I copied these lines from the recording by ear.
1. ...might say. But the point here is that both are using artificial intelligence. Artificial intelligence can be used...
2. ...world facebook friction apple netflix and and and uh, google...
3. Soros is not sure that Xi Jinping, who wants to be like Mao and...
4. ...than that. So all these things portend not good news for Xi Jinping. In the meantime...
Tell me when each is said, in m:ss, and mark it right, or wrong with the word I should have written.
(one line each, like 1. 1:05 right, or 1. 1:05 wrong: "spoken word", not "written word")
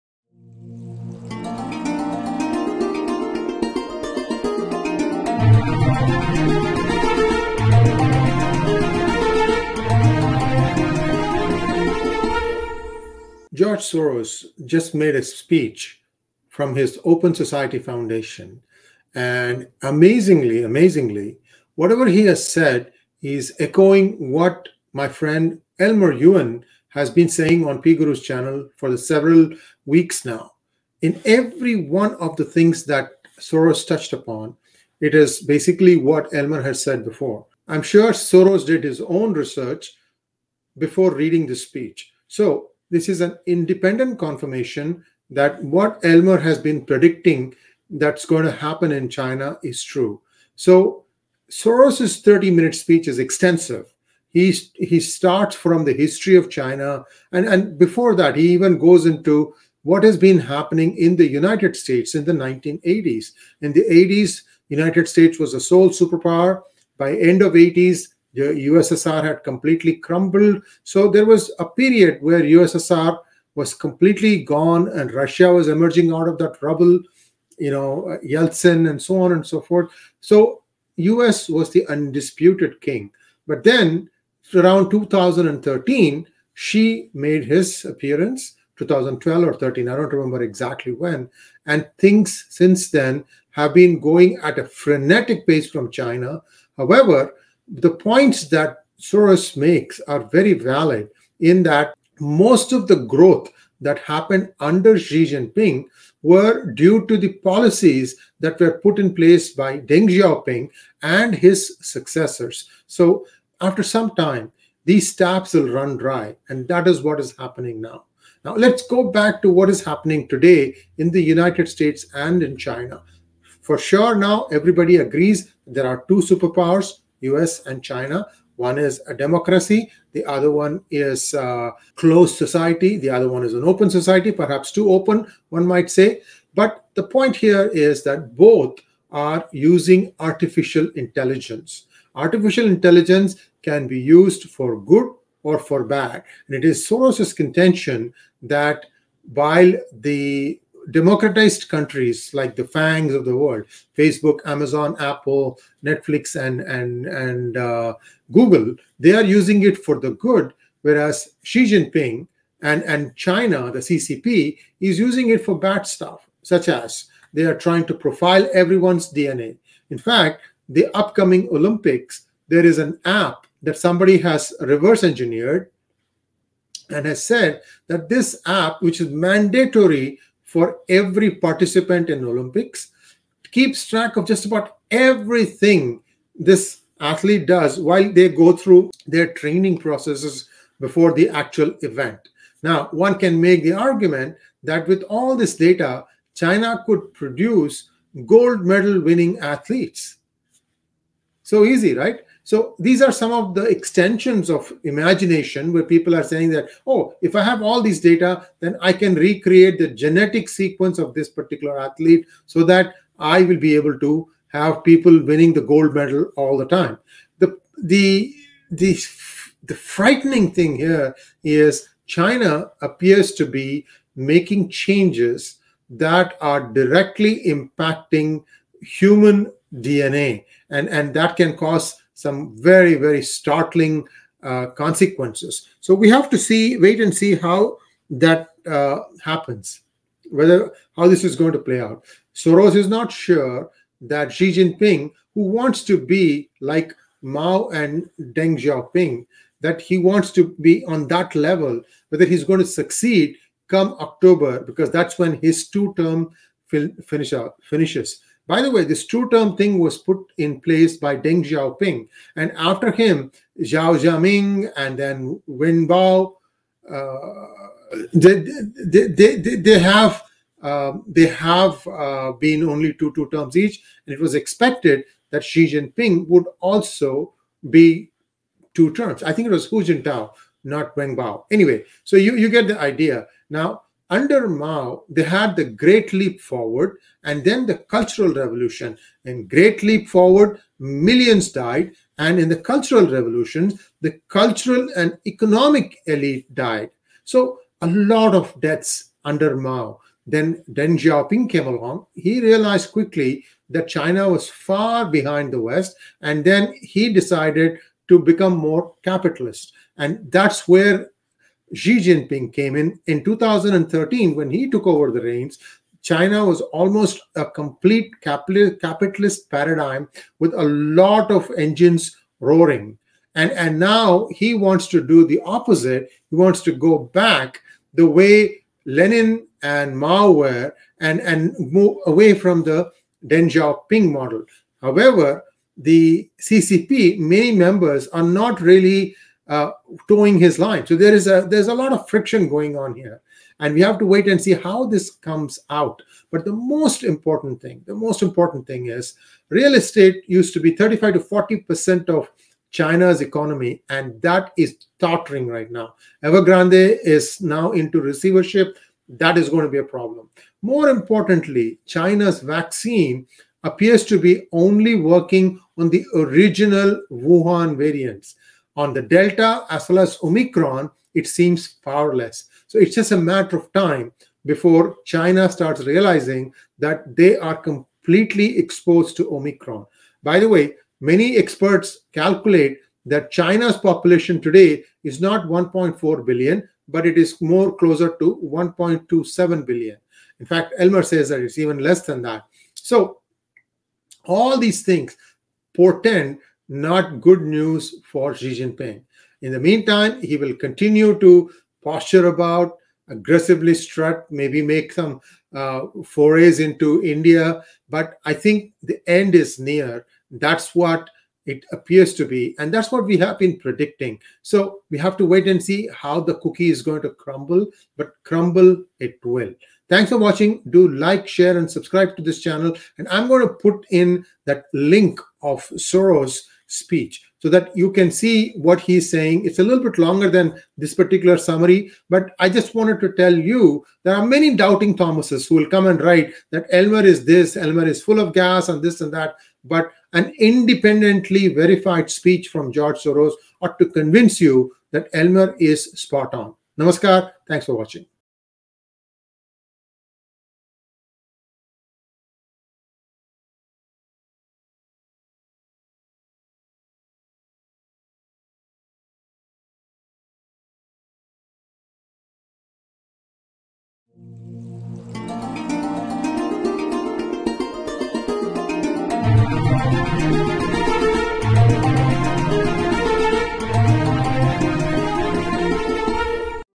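1. 2:15 right
2. 2:33 wrong: "amazon", not "friction"
3. 4:02 right
4. 6:32 right.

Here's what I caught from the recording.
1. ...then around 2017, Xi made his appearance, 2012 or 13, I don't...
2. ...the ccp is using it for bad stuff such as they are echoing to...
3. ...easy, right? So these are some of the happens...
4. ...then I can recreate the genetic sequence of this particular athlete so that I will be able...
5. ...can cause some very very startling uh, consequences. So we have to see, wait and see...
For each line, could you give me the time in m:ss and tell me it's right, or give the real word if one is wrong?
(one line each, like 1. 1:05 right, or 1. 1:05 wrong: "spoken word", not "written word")
1. 1:23 wrong: "2013", not "2017"
2. 2:43 wrong: "trying", not "echoing"
3. 3:21 wrong: "extensions", not "happens"
4. 3:28 right
5. 3:51 right.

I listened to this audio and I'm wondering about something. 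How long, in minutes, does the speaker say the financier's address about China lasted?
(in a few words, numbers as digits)
30.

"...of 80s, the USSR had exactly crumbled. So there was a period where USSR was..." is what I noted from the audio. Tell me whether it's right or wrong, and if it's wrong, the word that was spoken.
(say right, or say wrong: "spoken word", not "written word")
wrong: "completely", not "exactly".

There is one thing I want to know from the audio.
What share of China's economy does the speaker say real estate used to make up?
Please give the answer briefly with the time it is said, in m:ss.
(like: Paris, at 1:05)
35 to 40 percent, at 5:50.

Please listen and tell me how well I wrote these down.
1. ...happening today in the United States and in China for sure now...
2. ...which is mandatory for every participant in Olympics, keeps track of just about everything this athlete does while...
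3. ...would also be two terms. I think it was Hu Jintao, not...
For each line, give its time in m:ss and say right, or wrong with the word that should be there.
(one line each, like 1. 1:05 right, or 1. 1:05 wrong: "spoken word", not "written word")
1. 1:59 right
2. 2:58 right
3. 4:36 right.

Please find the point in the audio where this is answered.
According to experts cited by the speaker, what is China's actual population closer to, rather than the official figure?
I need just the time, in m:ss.
6:28.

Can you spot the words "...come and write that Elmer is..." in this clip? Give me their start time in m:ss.
7:15.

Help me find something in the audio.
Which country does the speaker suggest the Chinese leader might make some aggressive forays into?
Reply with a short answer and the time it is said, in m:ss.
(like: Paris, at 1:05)
India, at 6:47.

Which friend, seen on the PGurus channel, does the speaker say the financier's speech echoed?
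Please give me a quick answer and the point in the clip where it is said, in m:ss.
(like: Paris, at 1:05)
Elmer Yuan, at 0:25.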